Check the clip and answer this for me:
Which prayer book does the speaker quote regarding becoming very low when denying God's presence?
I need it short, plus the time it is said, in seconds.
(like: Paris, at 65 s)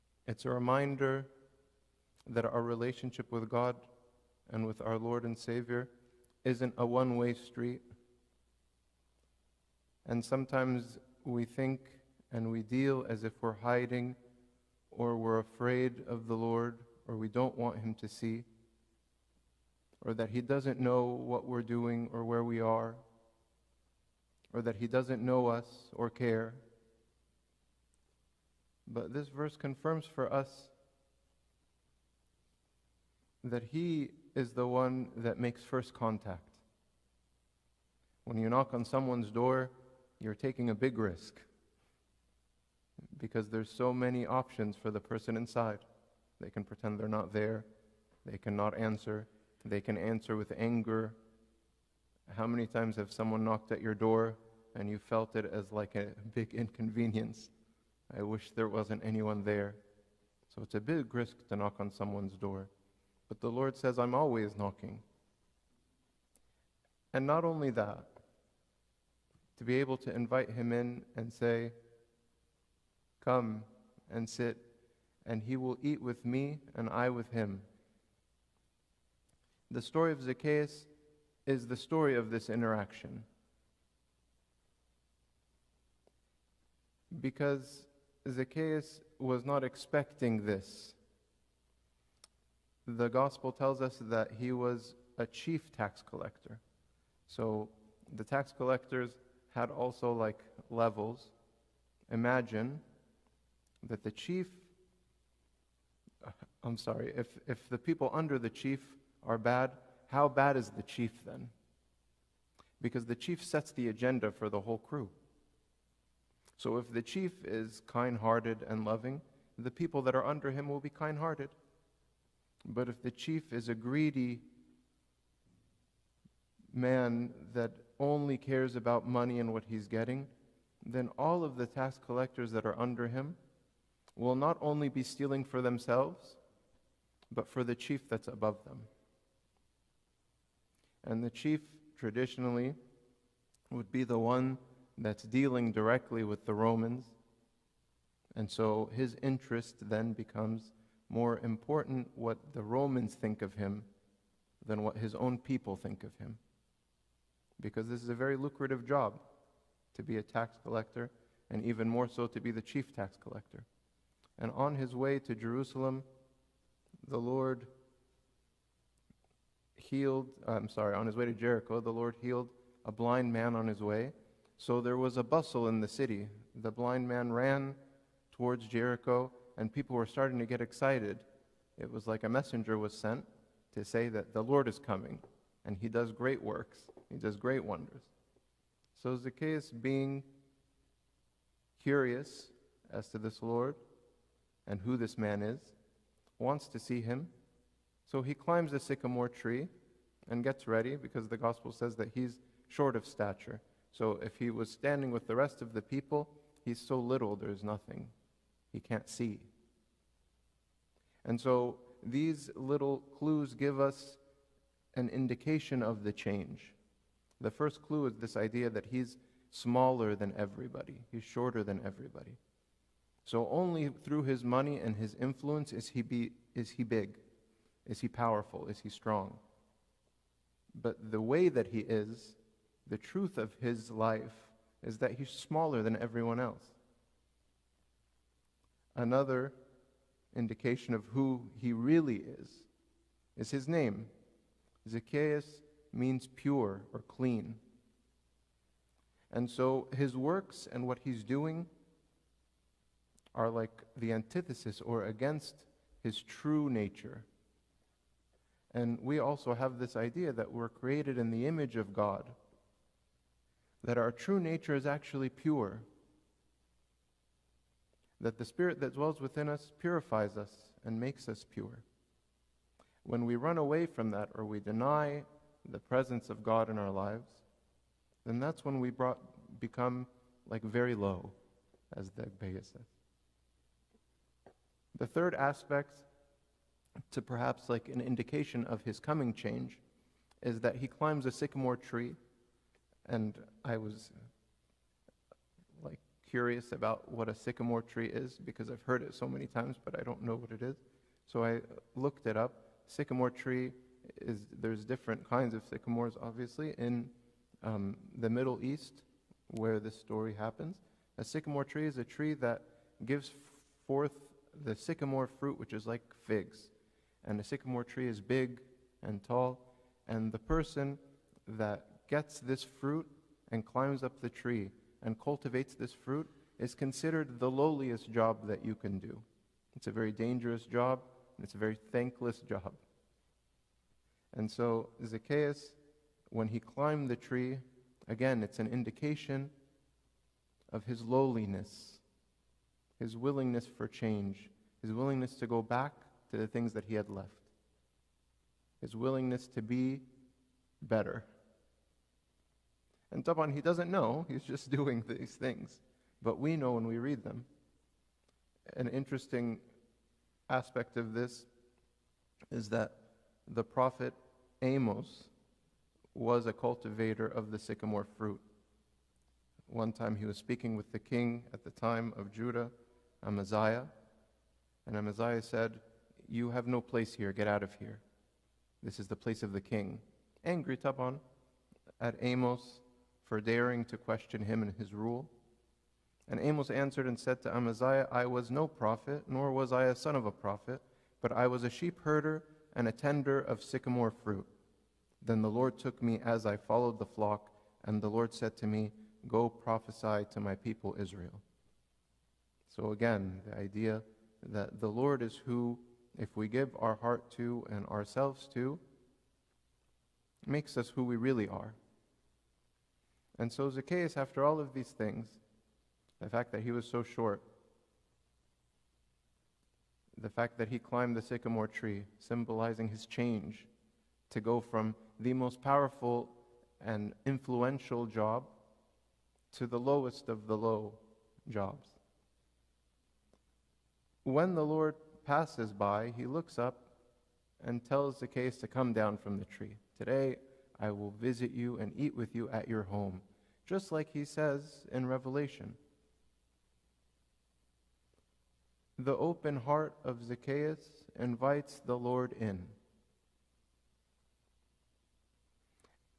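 Agbeya, at 282 s.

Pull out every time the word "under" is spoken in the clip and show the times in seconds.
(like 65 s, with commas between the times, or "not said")
108 s, 120 s, 132 s.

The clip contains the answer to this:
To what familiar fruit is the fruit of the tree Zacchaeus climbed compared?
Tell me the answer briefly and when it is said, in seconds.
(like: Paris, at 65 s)
Figs, at 316 s.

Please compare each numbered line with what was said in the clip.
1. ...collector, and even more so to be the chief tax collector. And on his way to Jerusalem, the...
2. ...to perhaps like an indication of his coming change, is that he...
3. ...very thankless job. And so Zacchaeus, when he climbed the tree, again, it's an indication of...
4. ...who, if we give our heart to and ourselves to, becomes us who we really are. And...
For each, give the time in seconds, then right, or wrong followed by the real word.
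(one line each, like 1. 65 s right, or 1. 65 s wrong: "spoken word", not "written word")
1. 160 s right
2. 287 s right
3. 331 s right
4. 405 s wrong: "makes", not "becomes".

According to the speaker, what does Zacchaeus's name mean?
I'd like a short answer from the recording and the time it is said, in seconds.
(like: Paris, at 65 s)
Pure or clean, at 246 s.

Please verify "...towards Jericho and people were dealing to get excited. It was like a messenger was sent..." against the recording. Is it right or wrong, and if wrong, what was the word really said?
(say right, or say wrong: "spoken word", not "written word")
wrong: "starting", not "dealing".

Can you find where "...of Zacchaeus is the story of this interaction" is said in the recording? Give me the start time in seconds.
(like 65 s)
80 s.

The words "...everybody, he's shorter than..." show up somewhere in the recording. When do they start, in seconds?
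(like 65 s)
220 s.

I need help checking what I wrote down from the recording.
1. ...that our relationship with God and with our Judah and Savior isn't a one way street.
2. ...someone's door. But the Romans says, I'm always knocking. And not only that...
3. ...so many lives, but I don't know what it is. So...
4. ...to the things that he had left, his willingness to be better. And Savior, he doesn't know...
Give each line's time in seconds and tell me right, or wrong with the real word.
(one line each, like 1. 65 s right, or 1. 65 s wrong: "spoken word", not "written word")
1. 2 s wrong: "Lord", not "Judah"
2. 61 s wrong: "Lord", not "Romans"
3. 299 s wrong: "times", not "lives"
4. 346 s wrong: "Taban", not "Savior".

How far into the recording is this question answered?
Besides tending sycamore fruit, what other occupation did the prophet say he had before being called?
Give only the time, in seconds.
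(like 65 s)
391 s.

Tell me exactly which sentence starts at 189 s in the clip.
So Zacchaeus, being curious as to this Lord and who this man is, wants to see him.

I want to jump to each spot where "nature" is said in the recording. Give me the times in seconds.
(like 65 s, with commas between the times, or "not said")
256 s, 264 s.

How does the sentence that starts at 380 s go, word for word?
Angry Taban at Amos for daring to question him and his rule?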